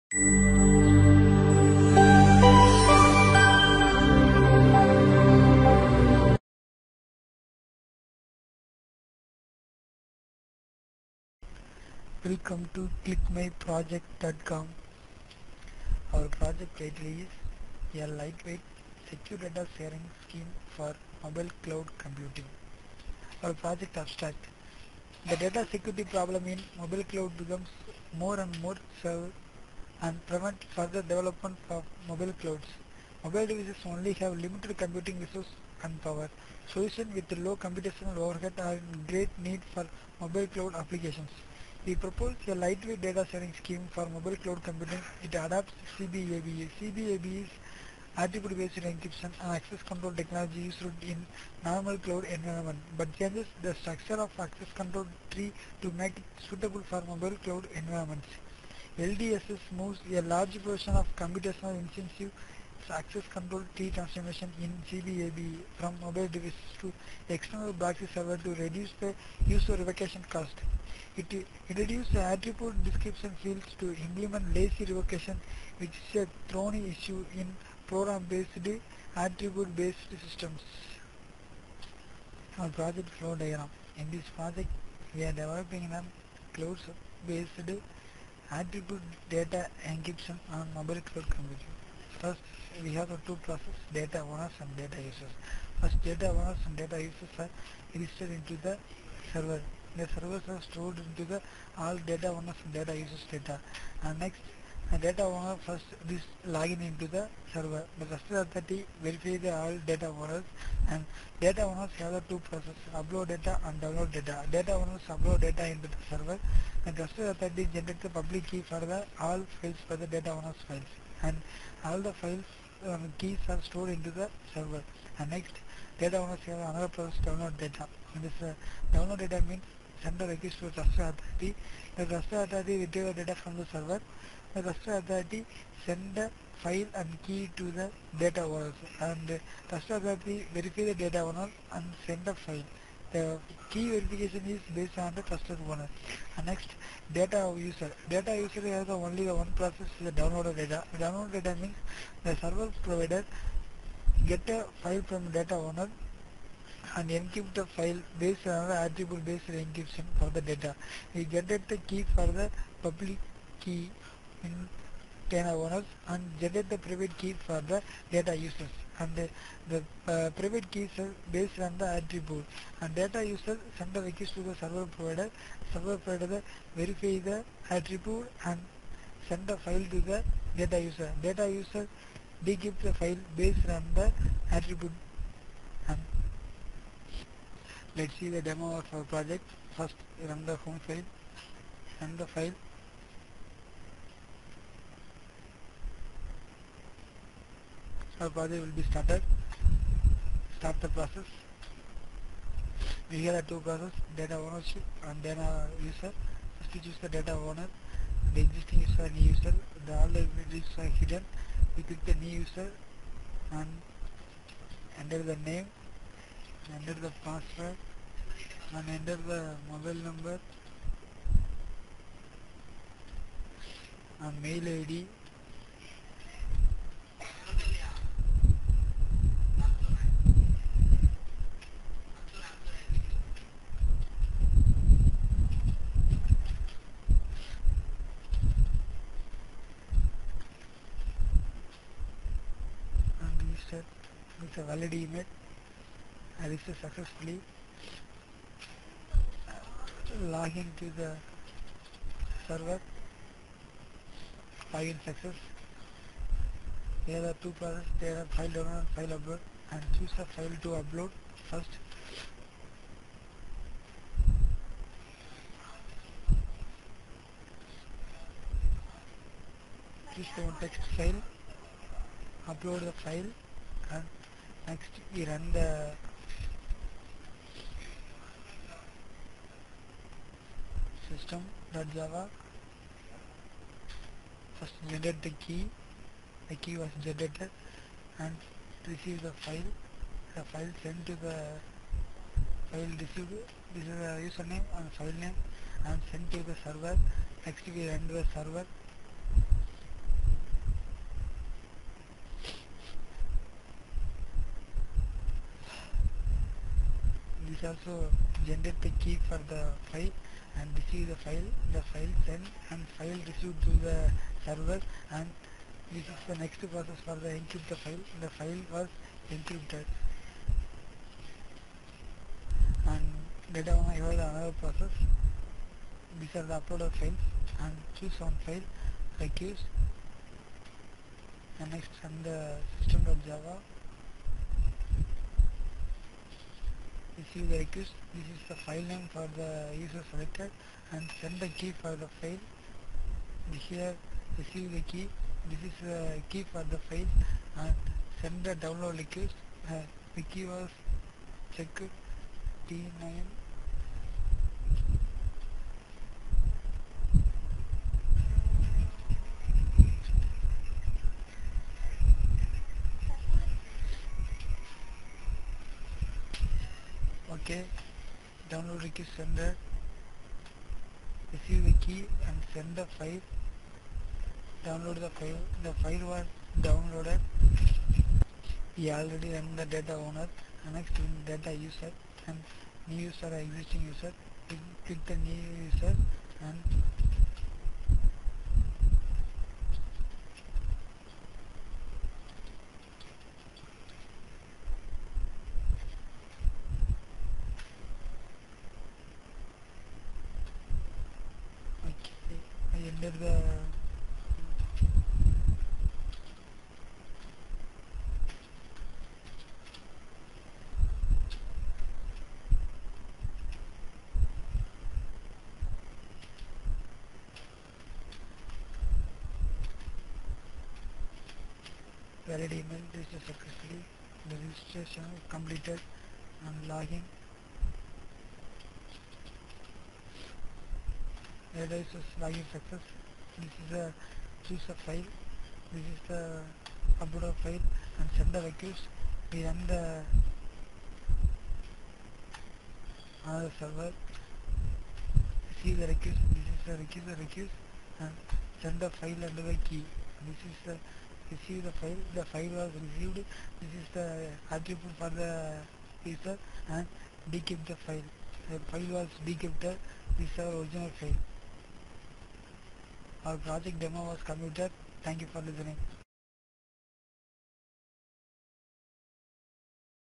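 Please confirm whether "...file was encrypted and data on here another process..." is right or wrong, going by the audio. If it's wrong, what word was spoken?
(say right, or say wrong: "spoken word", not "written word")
right.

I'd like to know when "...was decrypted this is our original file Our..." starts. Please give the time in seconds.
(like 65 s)
458 s.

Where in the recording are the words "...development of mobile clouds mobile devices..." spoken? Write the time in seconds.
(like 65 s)
31 s.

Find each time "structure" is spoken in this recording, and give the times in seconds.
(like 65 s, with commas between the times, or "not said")
53 s.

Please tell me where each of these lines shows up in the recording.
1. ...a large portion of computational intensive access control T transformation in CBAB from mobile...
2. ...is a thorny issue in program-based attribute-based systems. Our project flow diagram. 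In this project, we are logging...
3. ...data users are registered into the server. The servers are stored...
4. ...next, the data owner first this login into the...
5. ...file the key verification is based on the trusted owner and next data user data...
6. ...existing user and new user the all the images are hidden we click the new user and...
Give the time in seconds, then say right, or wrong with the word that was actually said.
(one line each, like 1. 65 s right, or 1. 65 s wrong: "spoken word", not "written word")
1. 60 s right
2. 76 s wrong: "developing", not "logging"
3. 96 s right
4. 104 s right
5. 142 s right
6. 208 s right.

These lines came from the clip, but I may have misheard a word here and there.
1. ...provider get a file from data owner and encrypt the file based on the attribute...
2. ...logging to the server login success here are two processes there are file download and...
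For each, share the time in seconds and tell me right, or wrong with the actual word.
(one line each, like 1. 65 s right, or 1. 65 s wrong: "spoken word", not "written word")
1. 152 s right
2. 250 s right.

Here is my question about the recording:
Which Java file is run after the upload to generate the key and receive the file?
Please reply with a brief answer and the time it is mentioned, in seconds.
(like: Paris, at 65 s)
system.java, at 275 s.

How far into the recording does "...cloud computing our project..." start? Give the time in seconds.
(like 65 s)
21 s.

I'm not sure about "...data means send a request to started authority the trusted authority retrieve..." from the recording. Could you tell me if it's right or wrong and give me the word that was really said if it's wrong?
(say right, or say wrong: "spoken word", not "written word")
wrong: "trusted", not "started".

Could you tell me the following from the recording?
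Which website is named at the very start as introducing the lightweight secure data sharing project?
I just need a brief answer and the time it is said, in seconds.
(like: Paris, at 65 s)
clickmyproject.com, at 13 s.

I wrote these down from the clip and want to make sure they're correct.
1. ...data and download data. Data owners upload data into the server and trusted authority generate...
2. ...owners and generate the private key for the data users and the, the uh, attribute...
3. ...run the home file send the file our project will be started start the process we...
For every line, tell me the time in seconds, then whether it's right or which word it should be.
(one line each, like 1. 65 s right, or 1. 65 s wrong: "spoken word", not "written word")
1. 113 s right
2. 165 s wrong: "private", not "attribute"
3. 190 s right.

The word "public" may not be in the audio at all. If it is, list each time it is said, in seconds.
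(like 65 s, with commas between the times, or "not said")
118 s, 162 s.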